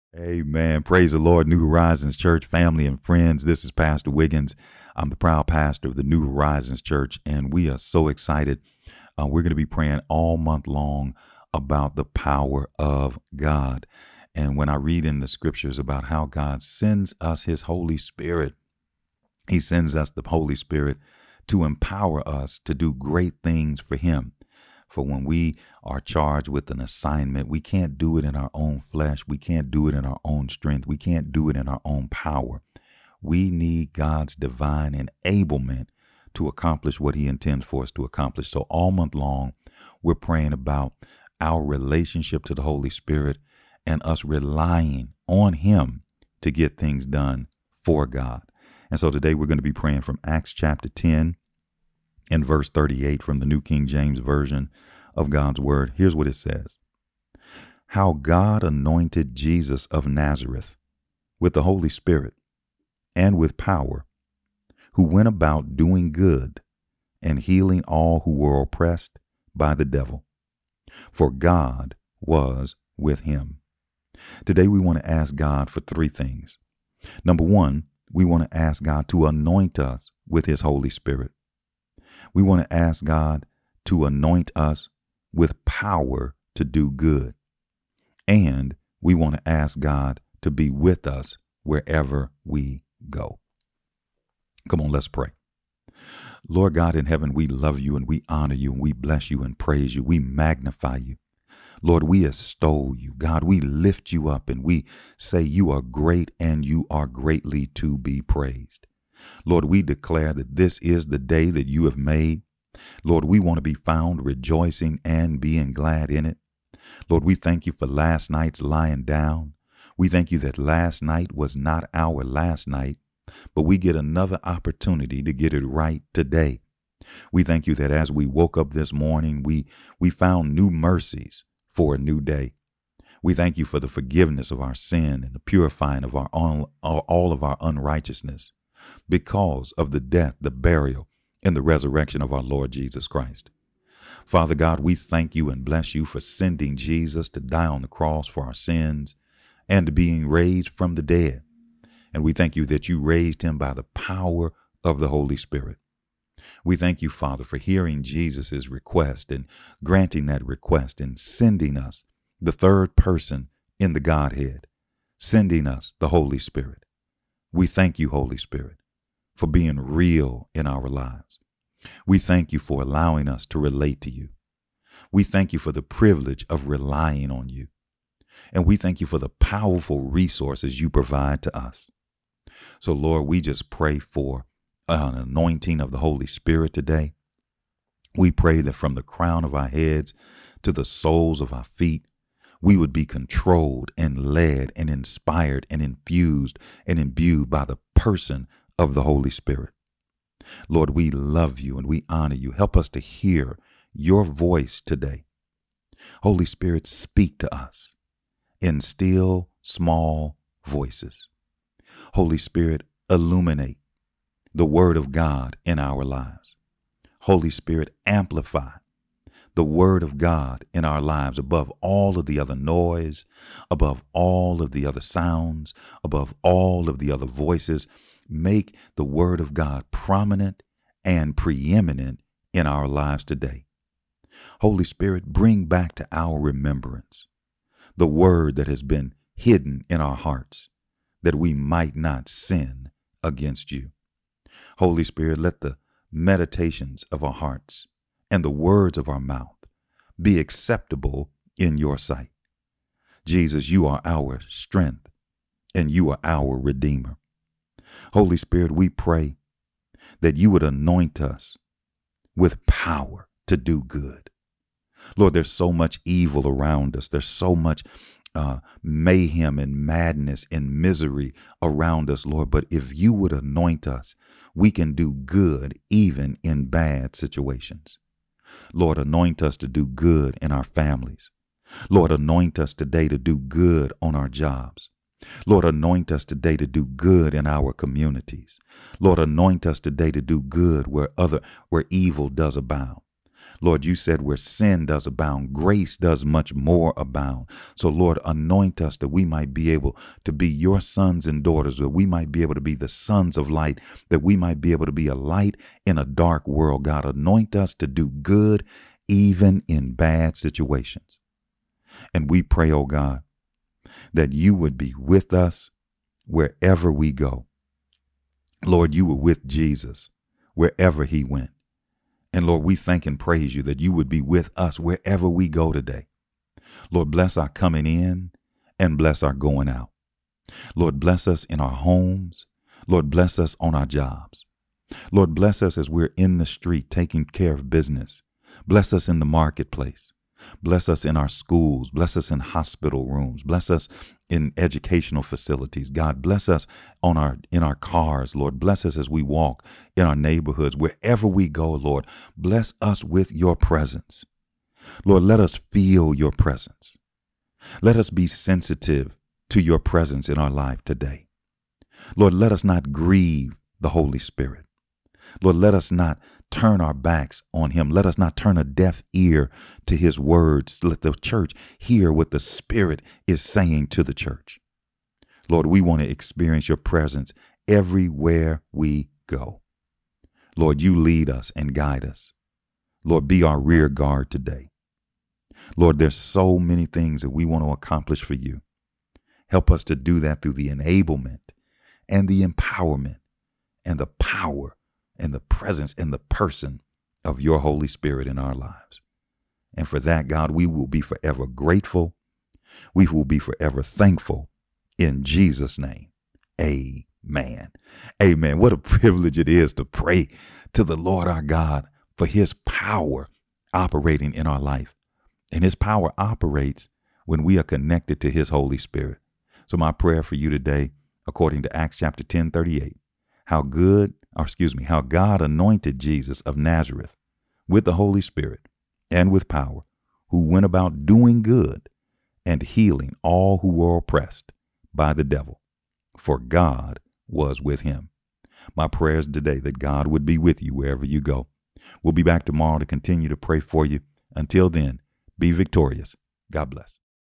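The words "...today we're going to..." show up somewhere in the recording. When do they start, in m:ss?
0:49.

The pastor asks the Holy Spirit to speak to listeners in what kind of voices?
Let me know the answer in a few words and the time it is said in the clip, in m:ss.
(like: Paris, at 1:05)
still, small voices, at 3:28.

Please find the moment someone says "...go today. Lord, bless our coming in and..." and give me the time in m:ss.
5:25.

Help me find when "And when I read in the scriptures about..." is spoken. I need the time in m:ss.
0:14.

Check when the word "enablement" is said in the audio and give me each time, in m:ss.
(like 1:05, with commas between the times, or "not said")
0:34, 6:30.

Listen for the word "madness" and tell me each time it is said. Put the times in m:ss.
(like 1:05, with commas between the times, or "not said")
4:29.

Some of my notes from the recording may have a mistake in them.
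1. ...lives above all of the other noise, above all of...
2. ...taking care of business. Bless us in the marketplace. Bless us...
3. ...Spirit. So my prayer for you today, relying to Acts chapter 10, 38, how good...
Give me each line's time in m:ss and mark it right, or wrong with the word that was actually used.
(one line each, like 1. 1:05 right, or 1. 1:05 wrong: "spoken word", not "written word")
1. 3:41 right
2. 5:36 right
3. 6:58 wrong: "according", not "relying".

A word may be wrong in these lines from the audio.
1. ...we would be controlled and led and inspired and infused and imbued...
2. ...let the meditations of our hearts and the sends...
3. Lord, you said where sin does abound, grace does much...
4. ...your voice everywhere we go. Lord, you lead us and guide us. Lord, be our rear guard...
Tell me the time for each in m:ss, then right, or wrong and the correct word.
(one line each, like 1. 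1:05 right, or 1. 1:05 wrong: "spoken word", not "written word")
1. 3:12 right
2. 4:05 wrong: "words", not "sends"
3. 4:53 right
4. 6:16 wrong: "presence", not "voice".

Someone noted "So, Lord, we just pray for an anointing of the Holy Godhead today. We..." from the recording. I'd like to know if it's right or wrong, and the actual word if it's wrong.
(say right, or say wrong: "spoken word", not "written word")
wrong: "Spirit", not "Godhead".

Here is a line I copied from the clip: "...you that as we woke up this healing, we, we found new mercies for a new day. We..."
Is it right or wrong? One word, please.
wrong.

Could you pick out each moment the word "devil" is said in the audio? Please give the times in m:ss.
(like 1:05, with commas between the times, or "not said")
1:09, 7:15.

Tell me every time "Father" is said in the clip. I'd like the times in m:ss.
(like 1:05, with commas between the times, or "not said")
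2:24, 2:37.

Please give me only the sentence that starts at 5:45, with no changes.
God bless us on our in our cars, Lord.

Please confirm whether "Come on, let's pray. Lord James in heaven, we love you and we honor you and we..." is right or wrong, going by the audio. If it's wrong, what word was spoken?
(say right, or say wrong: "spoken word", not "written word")
wrong: "God", not "James".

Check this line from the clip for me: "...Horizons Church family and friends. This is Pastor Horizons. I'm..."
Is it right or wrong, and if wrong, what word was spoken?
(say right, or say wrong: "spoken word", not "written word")
wrong: "Wiggins", not "Horizons".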